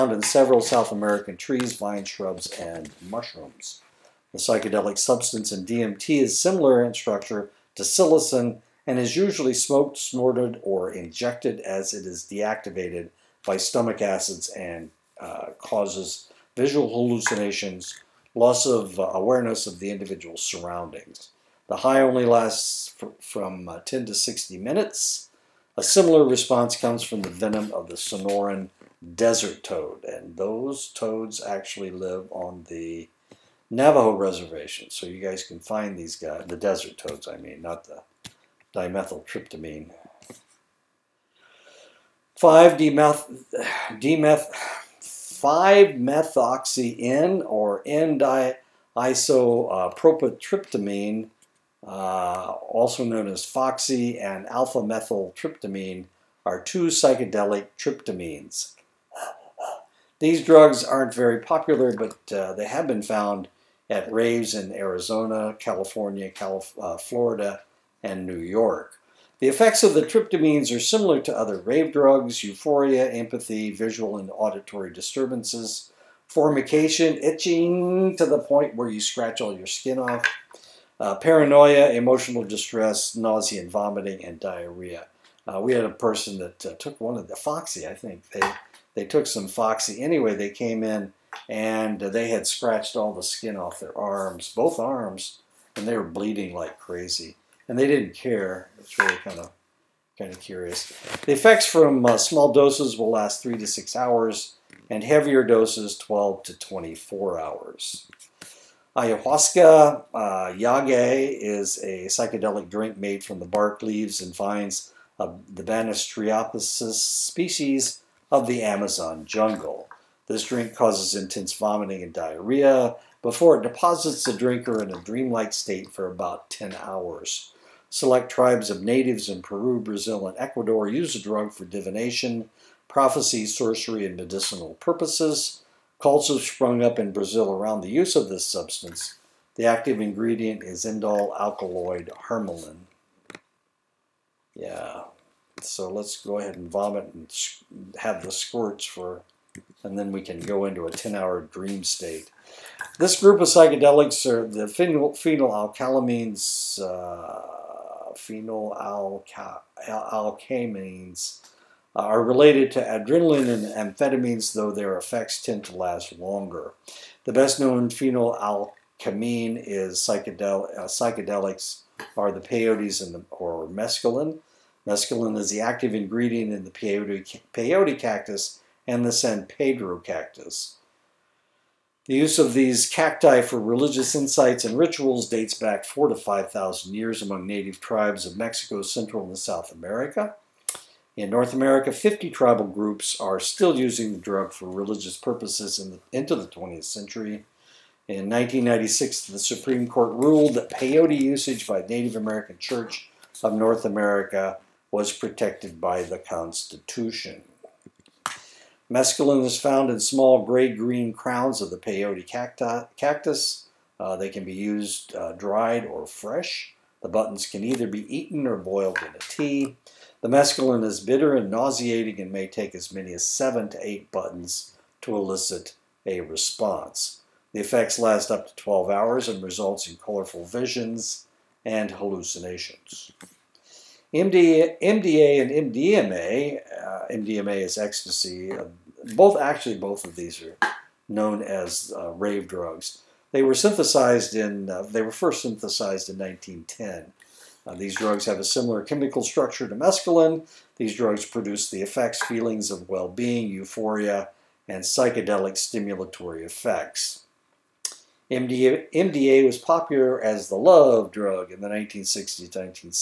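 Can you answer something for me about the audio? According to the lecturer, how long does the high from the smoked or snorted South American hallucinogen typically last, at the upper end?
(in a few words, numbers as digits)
60 minutes.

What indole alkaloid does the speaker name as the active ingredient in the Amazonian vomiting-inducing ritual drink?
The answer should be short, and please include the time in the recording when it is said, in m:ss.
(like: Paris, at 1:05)
Harmaline, at 2:22.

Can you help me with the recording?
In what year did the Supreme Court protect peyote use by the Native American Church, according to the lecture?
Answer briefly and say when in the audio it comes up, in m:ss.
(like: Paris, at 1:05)
1996, at 3:18.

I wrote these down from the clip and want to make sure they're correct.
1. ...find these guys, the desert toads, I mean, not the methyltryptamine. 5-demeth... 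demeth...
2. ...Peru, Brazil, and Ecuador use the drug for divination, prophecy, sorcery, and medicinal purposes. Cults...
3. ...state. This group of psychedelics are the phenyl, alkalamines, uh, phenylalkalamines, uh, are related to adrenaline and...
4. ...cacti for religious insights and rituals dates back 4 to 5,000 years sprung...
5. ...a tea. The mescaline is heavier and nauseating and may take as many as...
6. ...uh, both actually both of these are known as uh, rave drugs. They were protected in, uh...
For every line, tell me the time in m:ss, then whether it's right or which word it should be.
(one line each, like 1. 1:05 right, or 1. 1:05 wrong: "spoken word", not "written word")
1. 0:35 wrong: "dimethyltryptamine", not "methyltryptamine"
2. 2:09 right
3. 2:31 right
4. 3:02 wrong: "among", not "sprung"
5. 3:39 wrong: "bitter", not "heavier"
6. 3:58 wrong: "synthesized", not "protected".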